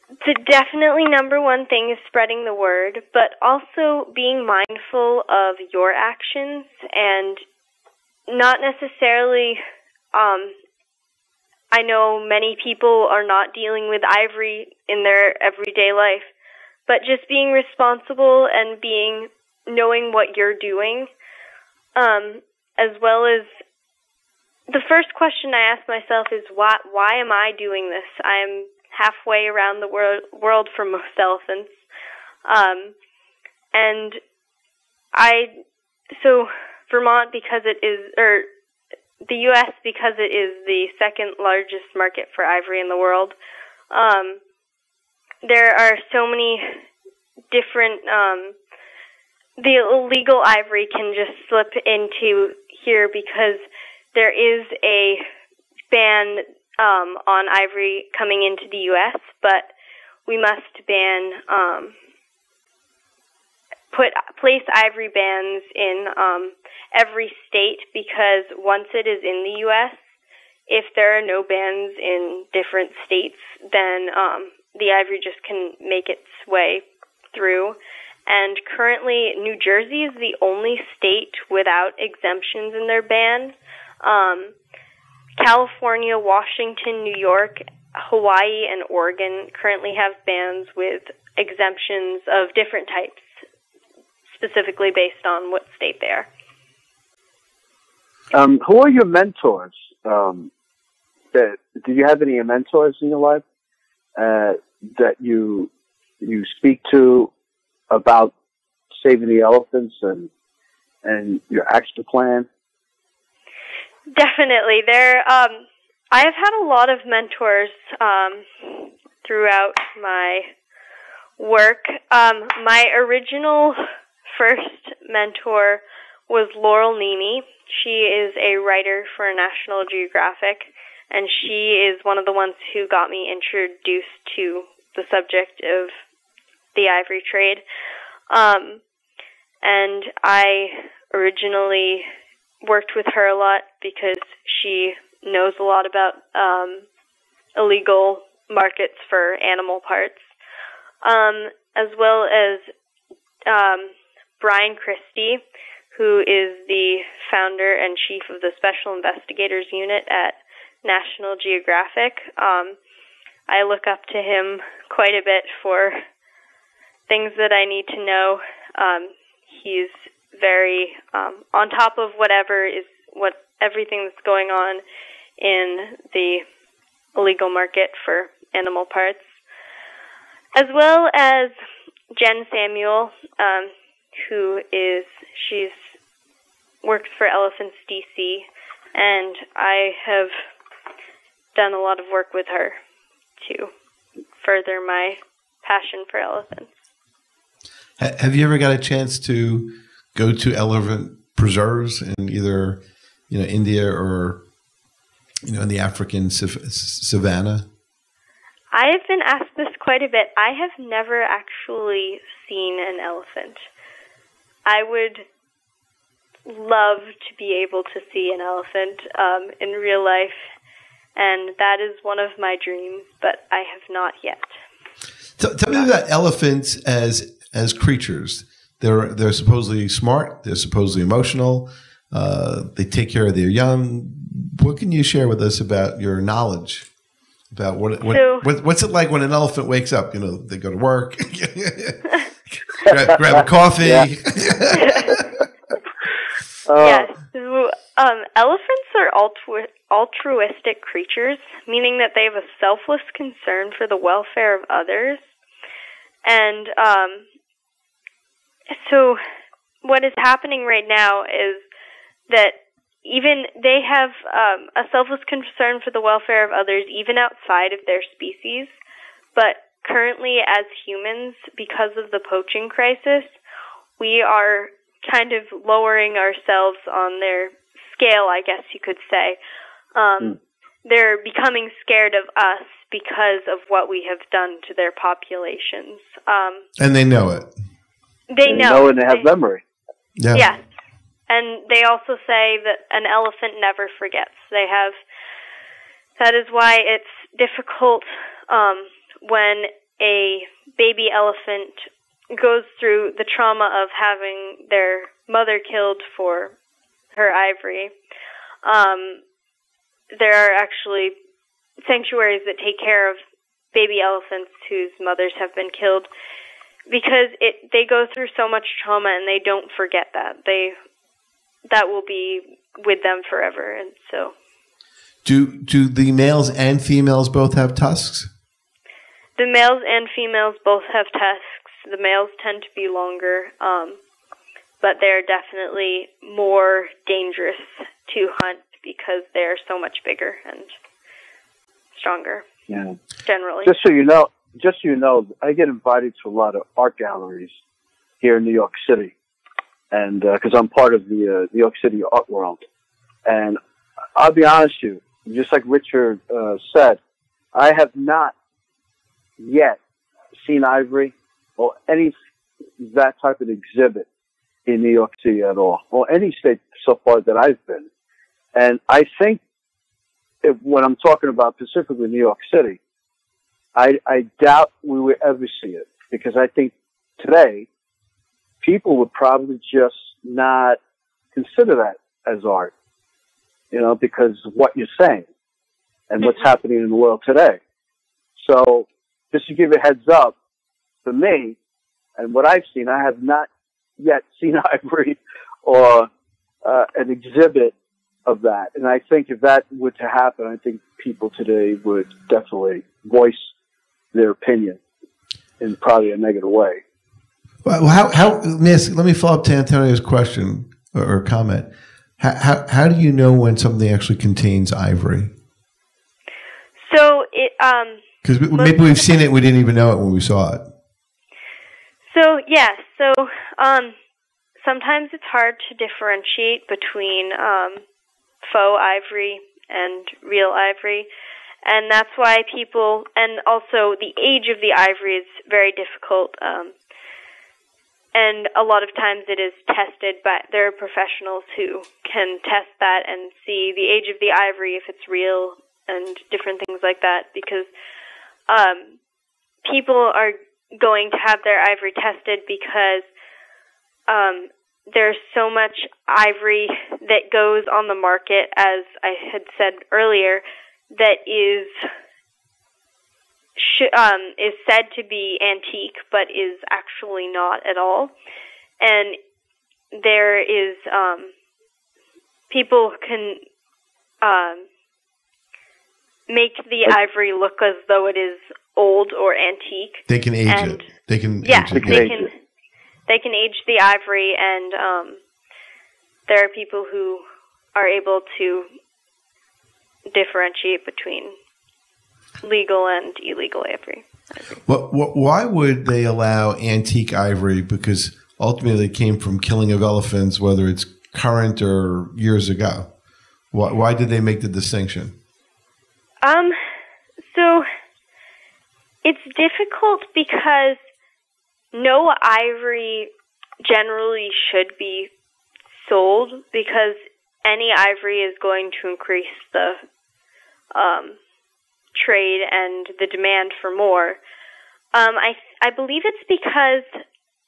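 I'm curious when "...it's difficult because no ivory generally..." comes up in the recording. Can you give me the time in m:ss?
8:29.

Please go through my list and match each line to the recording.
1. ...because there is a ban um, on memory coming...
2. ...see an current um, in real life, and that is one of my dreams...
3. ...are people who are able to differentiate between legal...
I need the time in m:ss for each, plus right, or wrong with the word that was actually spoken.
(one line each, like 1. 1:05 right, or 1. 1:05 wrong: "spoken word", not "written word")
1. 0:53 wrong: "ivory", not "memory"
2. 3:38 wrong: "elephant", not "current"
3. 8:06 right.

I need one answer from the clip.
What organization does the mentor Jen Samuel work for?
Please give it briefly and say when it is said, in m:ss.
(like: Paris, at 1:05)
Elephants DC, at 3:07.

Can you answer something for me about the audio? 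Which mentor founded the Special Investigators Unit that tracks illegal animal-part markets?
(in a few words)
Bryan Christy.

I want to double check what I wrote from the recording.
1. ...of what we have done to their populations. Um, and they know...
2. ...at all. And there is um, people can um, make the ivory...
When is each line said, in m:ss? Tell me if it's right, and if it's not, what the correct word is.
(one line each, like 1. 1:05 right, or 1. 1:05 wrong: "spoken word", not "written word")
1. 4:43 right
2. 7:47 right.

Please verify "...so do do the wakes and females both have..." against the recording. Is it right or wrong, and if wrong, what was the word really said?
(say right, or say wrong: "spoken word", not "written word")
wrong: "males", not "wakes".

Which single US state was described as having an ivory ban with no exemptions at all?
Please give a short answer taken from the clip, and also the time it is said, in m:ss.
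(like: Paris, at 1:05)
New Jersey, at 1:19.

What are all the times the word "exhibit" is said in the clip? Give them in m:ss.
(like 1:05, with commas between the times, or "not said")
6:03, 6:37.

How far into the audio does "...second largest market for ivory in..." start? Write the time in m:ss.
0:40.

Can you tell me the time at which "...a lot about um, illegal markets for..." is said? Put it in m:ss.
2:25.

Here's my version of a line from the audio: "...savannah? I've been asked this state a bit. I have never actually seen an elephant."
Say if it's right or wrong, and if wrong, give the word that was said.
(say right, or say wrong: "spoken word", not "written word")
wrong: "quite", not "state".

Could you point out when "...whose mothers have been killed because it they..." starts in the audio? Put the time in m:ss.
5:14.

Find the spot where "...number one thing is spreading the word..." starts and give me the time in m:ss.
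0:01.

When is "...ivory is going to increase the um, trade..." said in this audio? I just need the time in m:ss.
8:37.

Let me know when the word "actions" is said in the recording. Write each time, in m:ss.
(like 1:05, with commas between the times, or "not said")
0:05, 1:51.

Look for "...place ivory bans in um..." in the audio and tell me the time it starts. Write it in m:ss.
1:04.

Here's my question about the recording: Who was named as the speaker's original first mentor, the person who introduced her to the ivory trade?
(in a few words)
Laurel Neme.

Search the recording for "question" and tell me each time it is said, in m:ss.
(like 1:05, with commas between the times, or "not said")
0:25, 6:50.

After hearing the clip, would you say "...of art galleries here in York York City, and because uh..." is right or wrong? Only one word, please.
wrong.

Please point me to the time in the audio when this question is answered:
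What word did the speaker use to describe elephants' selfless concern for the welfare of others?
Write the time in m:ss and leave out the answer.
4:09.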